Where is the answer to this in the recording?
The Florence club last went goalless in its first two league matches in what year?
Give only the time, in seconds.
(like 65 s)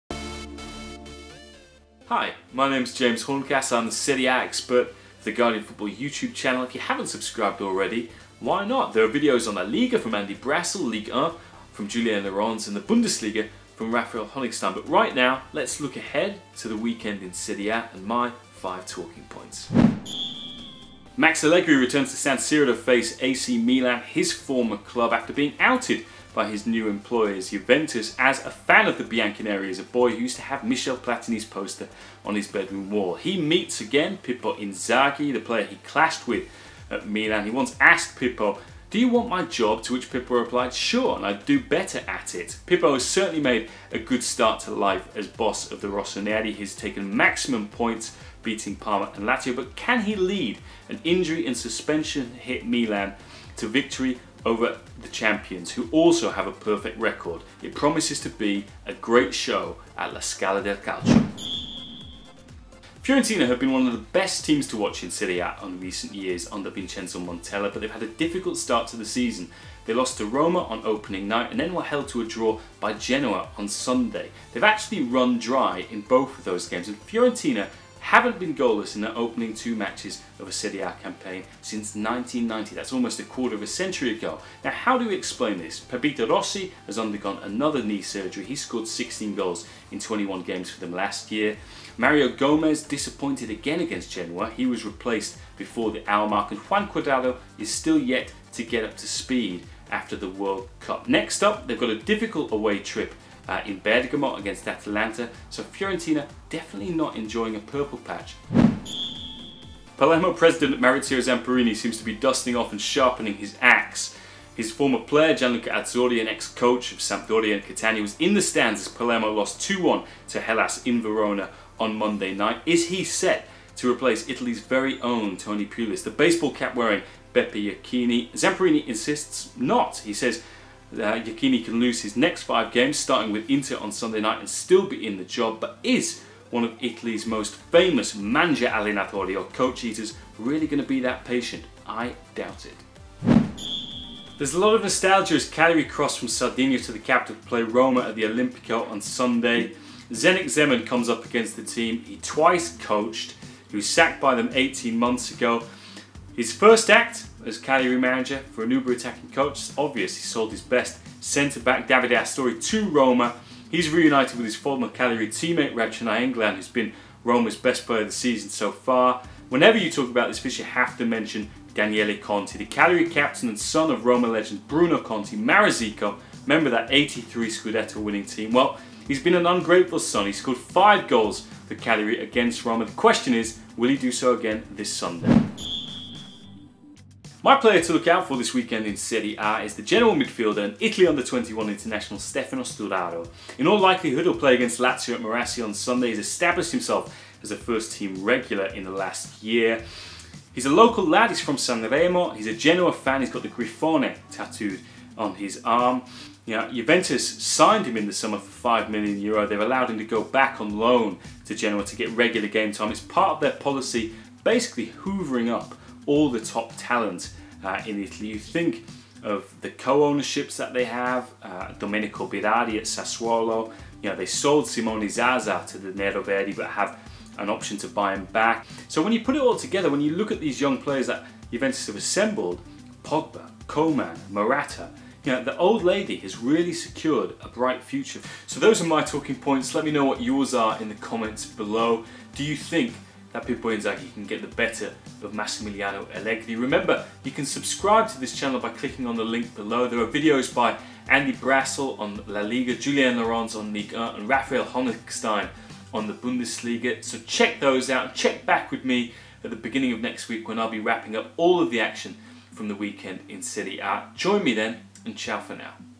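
81 s.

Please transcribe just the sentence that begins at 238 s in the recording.
So those are my talking points.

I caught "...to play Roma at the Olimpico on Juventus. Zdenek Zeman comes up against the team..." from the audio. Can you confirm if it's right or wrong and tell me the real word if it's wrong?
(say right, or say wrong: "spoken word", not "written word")
wrong: "Sunday", not "Juventus".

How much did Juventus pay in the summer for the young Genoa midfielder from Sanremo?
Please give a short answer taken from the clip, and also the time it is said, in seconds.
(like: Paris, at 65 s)
5 million euro, at 208 s.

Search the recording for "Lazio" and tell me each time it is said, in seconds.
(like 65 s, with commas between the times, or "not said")
49 s, 194 s.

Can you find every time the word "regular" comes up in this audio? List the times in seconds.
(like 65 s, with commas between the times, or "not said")
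198 s, 212 s.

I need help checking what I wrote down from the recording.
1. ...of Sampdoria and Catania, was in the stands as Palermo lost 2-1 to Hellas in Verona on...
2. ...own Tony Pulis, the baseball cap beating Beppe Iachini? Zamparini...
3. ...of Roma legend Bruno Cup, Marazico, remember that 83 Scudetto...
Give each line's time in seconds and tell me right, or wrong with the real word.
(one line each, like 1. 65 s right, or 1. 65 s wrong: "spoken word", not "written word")
1. 116 s right
2. 125 s wrong: "wearing", not "beating"
3. 173 s wrong: "Conti", not "Cup".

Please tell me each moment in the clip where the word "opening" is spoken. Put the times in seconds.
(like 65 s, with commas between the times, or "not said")
70 s, 79 s.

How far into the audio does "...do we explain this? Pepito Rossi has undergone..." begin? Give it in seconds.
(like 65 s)
84 s.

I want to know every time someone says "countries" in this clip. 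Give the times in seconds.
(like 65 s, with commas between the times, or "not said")
not said.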